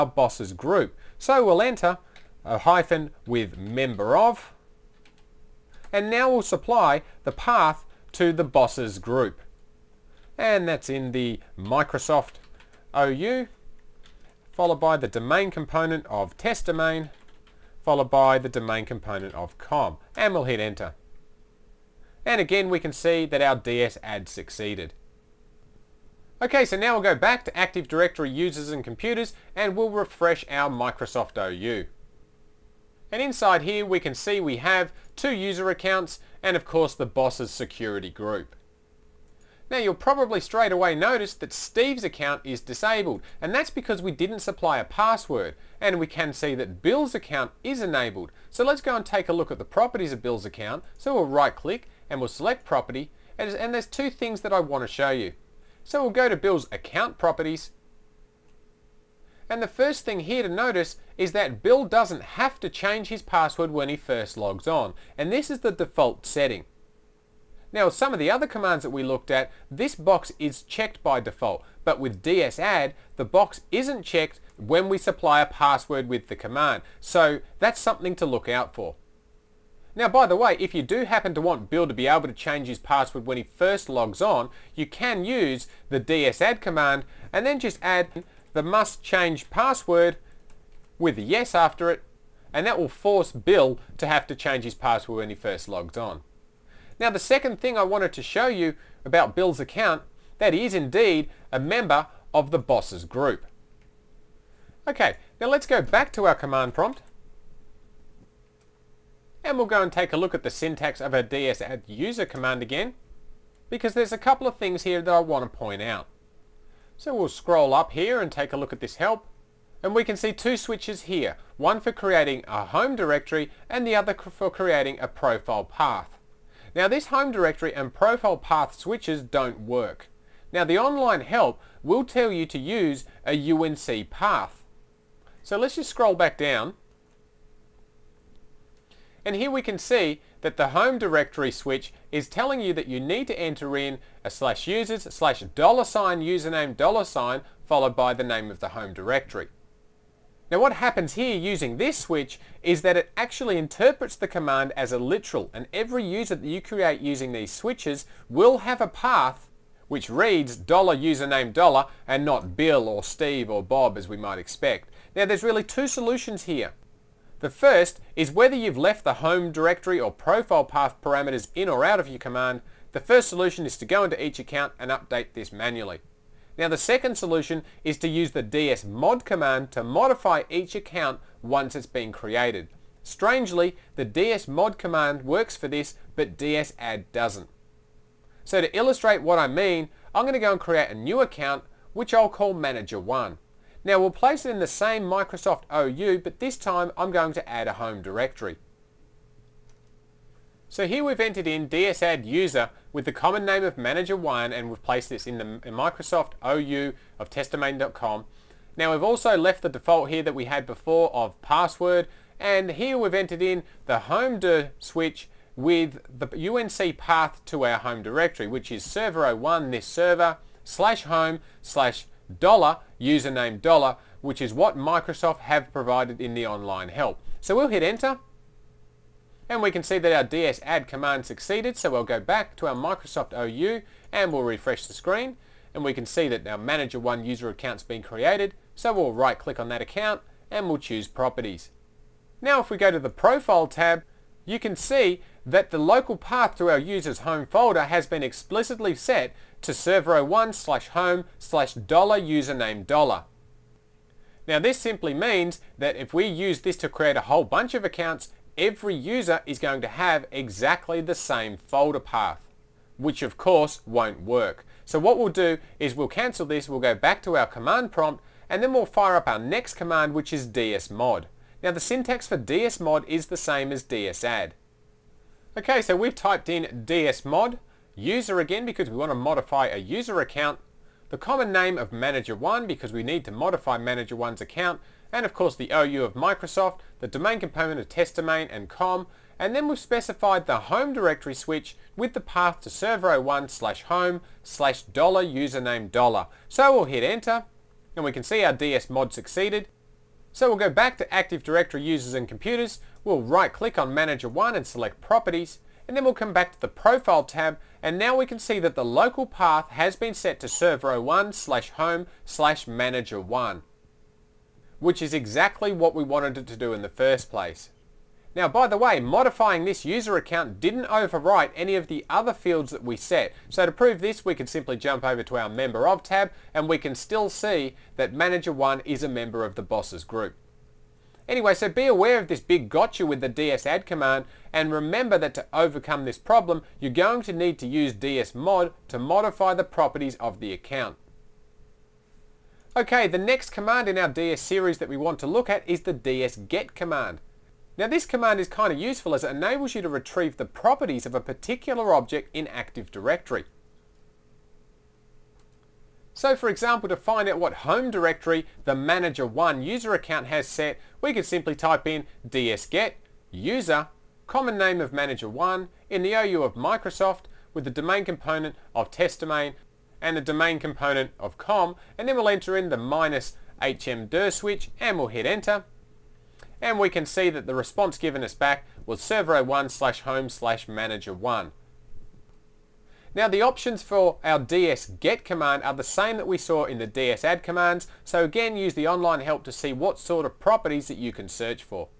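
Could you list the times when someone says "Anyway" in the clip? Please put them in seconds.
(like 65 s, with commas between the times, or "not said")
331 s.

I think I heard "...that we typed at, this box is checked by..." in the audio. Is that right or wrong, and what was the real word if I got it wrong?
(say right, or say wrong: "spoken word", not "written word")
wrong: "looked", not "typed".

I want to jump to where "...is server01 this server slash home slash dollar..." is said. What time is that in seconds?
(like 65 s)
218 s.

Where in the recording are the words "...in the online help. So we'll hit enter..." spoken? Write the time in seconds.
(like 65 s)
226 s.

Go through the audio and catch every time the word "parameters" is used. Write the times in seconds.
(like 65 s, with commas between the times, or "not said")
171 s.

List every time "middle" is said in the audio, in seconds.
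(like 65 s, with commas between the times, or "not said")
not said.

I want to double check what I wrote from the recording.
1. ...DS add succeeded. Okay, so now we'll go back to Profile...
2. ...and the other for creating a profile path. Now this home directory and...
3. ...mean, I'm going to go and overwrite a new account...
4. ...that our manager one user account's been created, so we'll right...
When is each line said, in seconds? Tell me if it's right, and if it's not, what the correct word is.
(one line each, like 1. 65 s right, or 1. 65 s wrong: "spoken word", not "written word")
1. 23 s wrong: "Active", not "Profile"
2. 123 s right
3. 189 s wrong: "create", not "overwrite"
4. 236 s right.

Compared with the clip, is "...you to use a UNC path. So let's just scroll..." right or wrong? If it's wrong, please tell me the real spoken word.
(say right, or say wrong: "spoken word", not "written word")
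right.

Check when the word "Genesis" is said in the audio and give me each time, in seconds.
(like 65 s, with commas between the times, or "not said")
not said.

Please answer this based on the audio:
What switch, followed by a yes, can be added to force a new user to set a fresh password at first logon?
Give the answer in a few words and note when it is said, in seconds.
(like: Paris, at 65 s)
must change password, at 88 s.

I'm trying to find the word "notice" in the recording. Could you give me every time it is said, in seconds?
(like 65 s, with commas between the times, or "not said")
40 s, 60 s.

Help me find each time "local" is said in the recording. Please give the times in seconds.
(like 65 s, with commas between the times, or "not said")
245 s, 308 s.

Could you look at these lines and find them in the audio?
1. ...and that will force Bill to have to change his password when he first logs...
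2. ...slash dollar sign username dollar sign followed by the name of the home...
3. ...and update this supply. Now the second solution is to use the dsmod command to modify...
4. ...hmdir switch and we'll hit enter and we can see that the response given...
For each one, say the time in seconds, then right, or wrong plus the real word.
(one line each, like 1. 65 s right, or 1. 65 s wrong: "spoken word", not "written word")
1. 92 s right
2. 145 s right
3. 174 s wrong: "manually", not "supply"
4. 373 s right.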